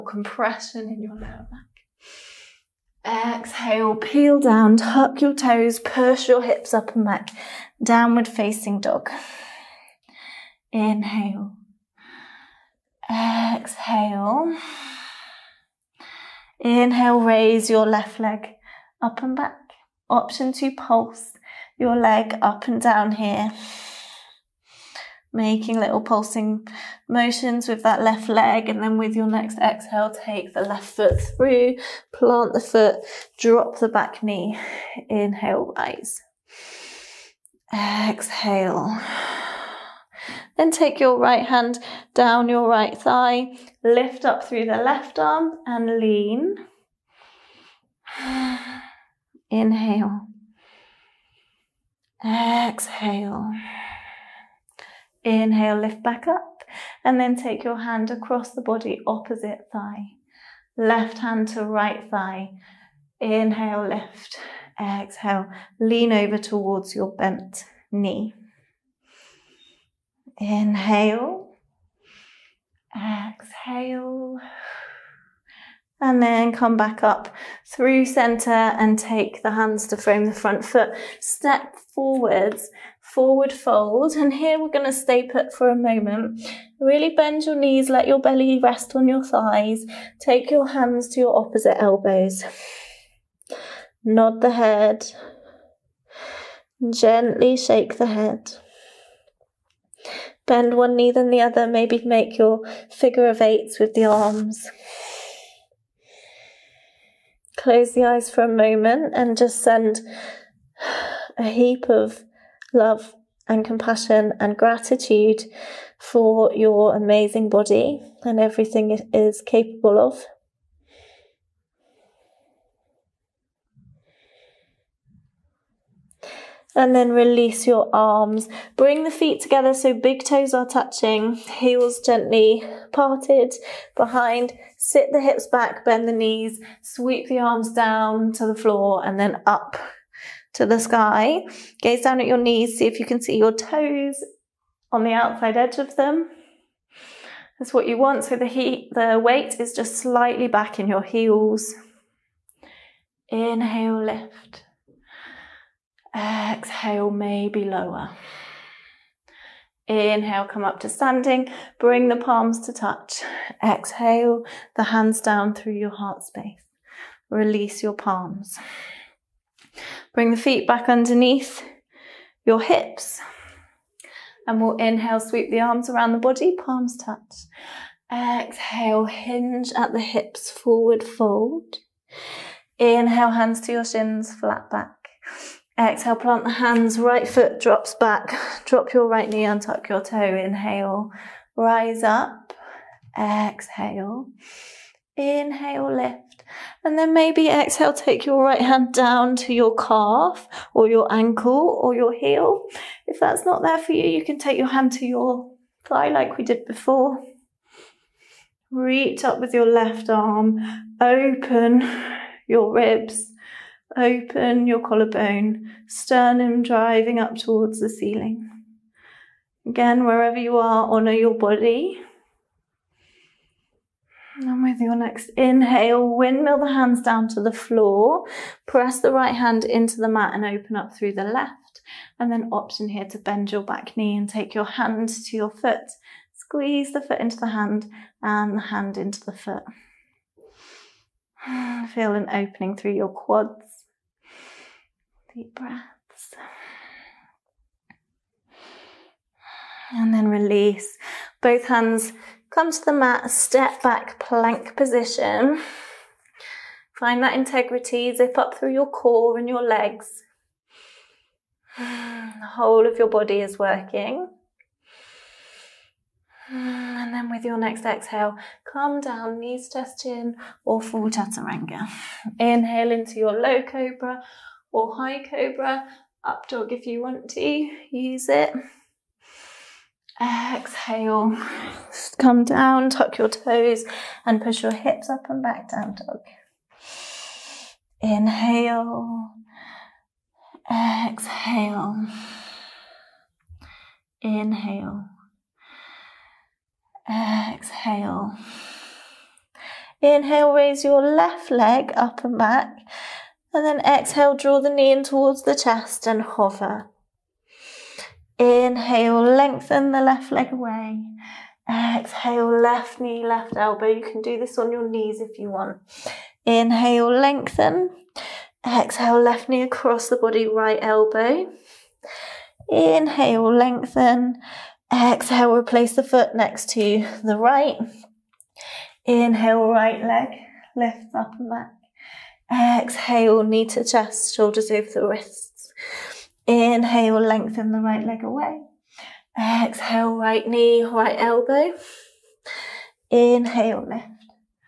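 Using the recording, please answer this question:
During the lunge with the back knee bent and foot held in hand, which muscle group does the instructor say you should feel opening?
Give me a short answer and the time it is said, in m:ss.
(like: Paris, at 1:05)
Quads, at 4:03.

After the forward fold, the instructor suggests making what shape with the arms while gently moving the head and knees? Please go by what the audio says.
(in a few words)
Figure of eights.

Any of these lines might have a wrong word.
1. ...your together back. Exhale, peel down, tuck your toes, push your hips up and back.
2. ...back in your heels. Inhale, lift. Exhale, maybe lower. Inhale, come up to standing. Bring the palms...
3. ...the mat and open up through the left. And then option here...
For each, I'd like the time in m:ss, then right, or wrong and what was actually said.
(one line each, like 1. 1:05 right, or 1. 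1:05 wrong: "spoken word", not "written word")
1. 0:01 wrong: "lower", not "together"
2. 2:30 right
3. 3:49 right.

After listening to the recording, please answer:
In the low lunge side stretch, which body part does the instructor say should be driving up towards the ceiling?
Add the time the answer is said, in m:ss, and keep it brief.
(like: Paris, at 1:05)
Sternum, at 3:35.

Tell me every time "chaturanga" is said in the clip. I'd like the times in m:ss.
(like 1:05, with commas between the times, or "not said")
4:31.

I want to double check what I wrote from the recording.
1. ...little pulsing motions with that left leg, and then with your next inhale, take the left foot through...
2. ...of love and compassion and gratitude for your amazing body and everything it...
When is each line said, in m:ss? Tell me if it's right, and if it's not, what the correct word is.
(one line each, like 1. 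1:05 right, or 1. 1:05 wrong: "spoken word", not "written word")
1. 0:25 wrong: "exhale", not "inhale"
2. 1:51 right.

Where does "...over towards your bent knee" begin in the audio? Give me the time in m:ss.
1:06.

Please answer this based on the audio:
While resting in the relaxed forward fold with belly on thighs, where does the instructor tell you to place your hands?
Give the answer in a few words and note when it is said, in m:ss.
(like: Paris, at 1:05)
Opposite elbows, at 1:31.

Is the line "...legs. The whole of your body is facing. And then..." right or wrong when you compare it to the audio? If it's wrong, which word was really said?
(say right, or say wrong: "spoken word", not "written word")
wrong: "working", not "facing".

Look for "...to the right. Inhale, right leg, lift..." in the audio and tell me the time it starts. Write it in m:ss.
5:26.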